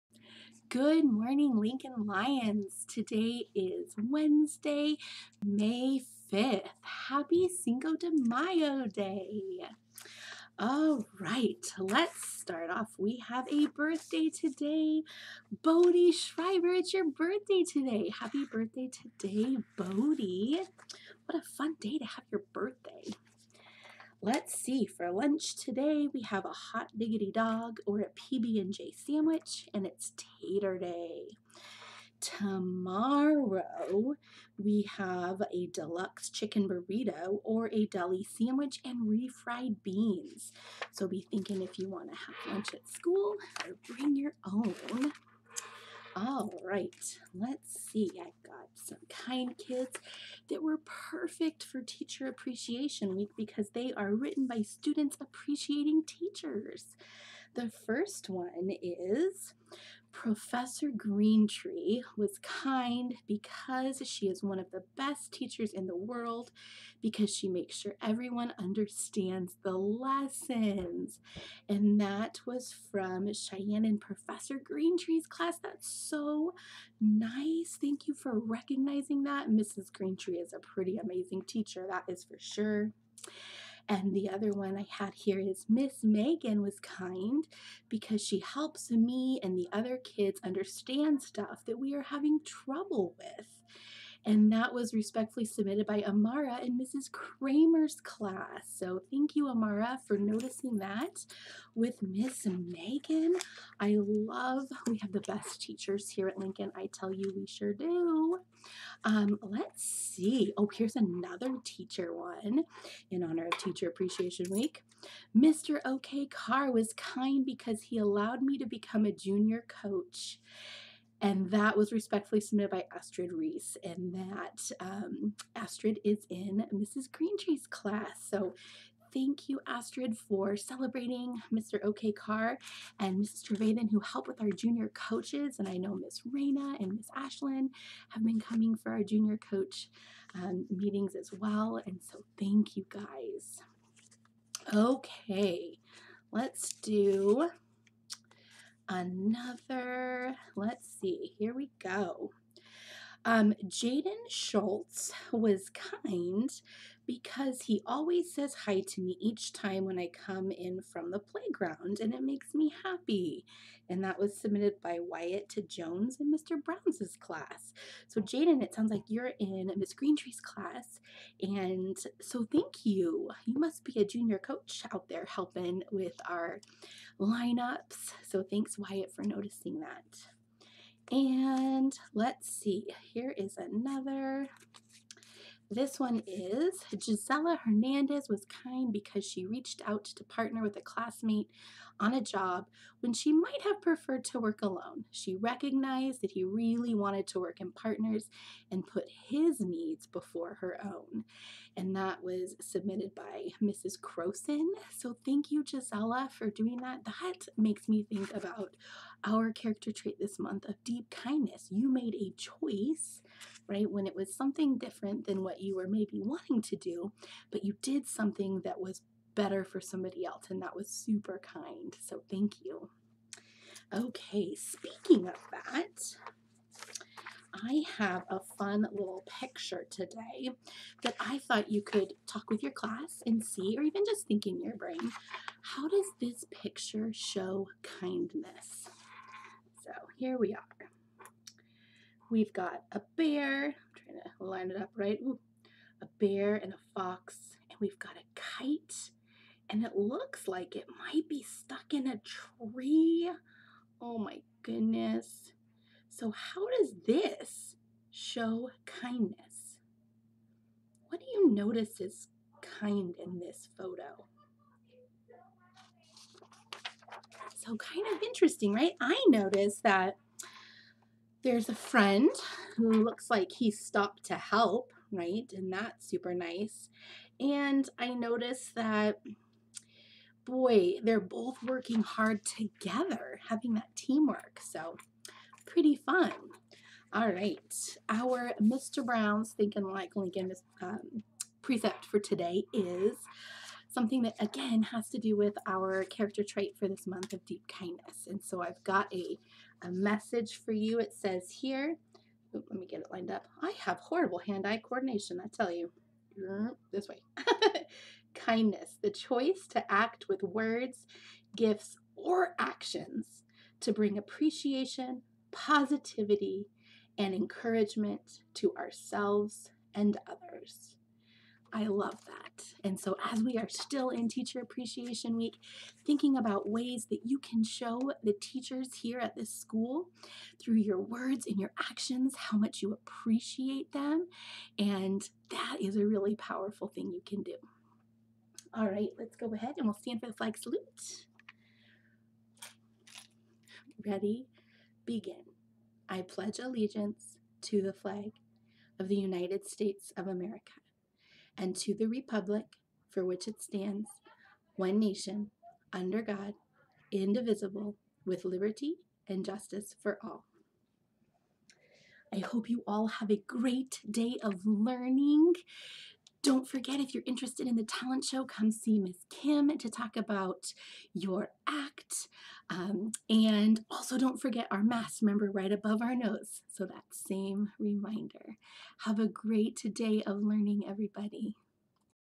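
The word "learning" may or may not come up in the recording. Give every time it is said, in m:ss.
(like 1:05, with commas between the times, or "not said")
6:04, 6:20.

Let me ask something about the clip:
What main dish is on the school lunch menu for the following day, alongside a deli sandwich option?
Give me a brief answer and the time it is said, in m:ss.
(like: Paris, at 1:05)
deluxe chicken burrito, at 0:35.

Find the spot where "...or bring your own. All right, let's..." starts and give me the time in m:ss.
0:43.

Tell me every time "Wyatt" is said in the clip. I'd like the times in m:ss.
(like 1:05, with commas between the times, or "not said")
2:45, 2:58.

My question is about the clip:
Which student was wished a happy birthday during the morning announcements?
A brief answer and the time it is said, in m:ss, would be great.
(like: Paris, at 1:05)
Bodie Schreiber, at 0:15.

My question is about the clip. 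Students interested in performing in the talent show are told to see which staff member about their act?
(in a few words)
Miss Kim.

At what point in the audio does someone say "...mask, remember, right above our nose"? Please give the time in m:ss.
6:14.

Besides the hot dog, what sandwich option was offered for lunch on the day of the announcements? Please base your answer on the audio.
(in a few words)
PB&J sandwich.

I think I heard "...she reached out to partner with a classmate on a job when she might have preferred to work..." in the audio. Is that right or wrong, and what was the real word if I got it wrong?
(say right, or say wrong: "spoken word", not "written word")
right.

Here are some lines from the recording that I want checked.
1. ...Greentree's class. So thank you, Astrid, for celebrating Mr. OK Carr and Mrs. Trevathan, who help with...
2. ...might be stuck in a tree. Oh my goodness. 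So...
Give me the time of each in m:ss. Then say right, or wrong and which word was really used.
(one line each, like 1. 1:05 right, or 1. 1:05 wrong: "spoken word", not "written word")
1. 2:07 right
2. 4:11 right.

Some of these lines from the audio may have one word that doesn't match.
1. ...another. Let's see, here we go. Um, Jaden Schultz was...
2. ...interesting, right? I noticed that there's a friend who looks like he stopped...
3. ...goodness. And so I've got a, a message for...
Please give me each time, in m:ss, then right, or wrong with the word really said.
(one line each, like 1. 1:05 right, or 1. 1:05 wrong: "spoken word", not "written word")
1. 2:28 right
2. 4:28 right
3. 4:57 wrong: "kindness", not "goodness".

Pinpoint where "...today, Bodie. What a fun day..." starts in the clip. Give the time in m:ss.
0:19.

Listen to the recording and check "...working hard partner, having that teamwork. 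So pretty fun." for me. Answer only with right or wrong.
wrong.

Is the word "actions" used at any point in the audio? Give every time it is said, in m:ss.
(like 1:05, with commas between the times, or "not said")
5:12, 5:31.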